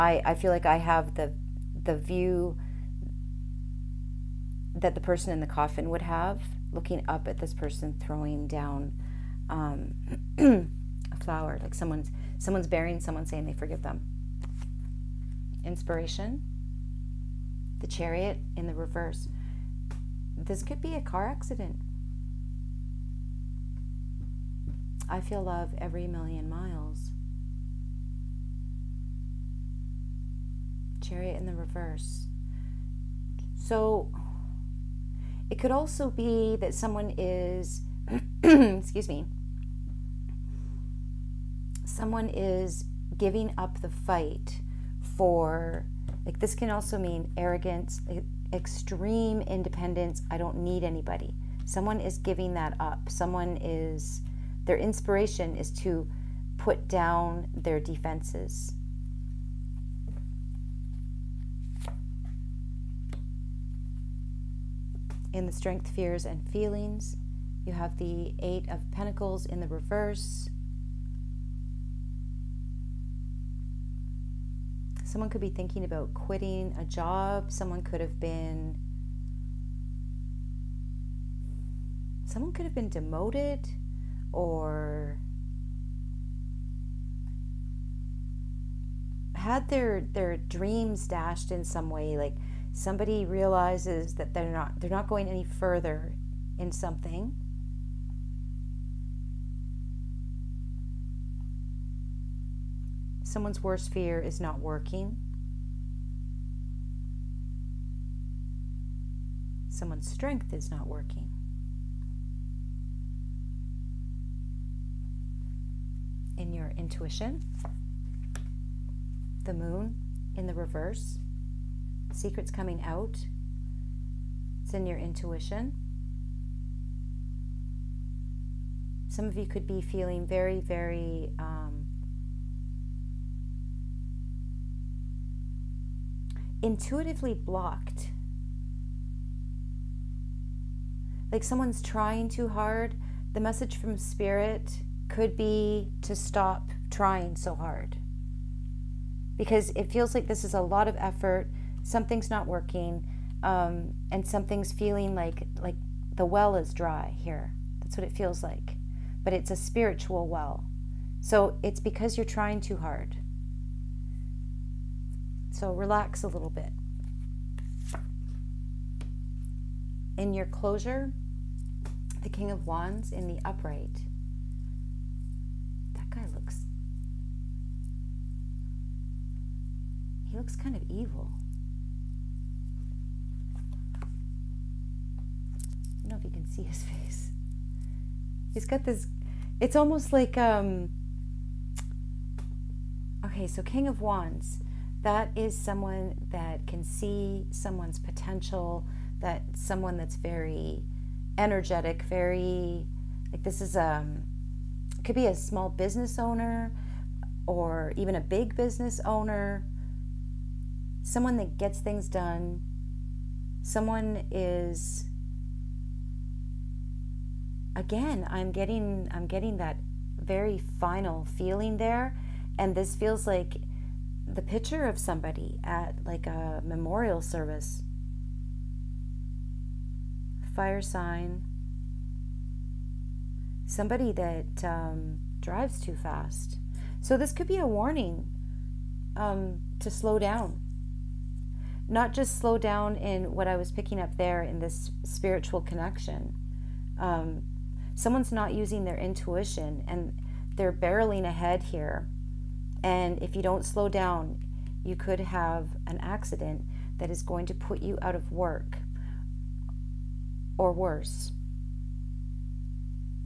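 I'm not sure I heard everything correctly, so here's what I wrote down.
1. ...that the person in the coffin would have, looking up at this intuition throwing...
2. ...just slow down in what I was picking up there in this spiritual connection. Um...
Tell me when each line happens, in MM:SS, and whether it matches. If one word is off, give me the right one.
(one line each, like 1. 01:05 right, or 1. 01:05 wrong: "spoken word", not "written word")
1. 00:04 wrong: "person", not "intuition"
2. 04:02 right.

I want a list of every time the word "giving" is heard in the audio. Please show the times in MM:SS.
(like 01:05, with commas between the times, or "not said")
00:43, 00:52.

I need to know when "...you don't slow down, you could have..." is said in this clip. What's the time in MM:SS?
04:13.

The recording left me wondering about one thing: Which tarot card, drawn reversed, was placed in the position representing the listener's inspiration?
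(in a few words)
The Chariot.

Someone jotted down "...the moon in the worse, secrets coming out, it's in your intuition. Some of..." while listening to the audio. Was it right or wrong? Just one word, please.
wrong.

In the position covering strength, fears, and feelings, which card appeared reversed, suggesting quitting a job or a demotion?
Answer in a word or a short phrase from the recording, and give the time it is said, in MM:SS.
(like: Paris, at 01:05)
Eight of Pentacles, at 01:08.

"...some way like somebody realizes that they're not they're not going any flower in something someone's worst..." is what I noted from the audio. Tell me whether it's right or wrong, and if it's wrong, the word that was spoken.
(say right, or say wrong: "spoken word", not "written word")
wrong: "further", not "flower".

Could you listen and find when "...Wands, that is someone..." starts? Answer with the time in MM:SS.
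03:13.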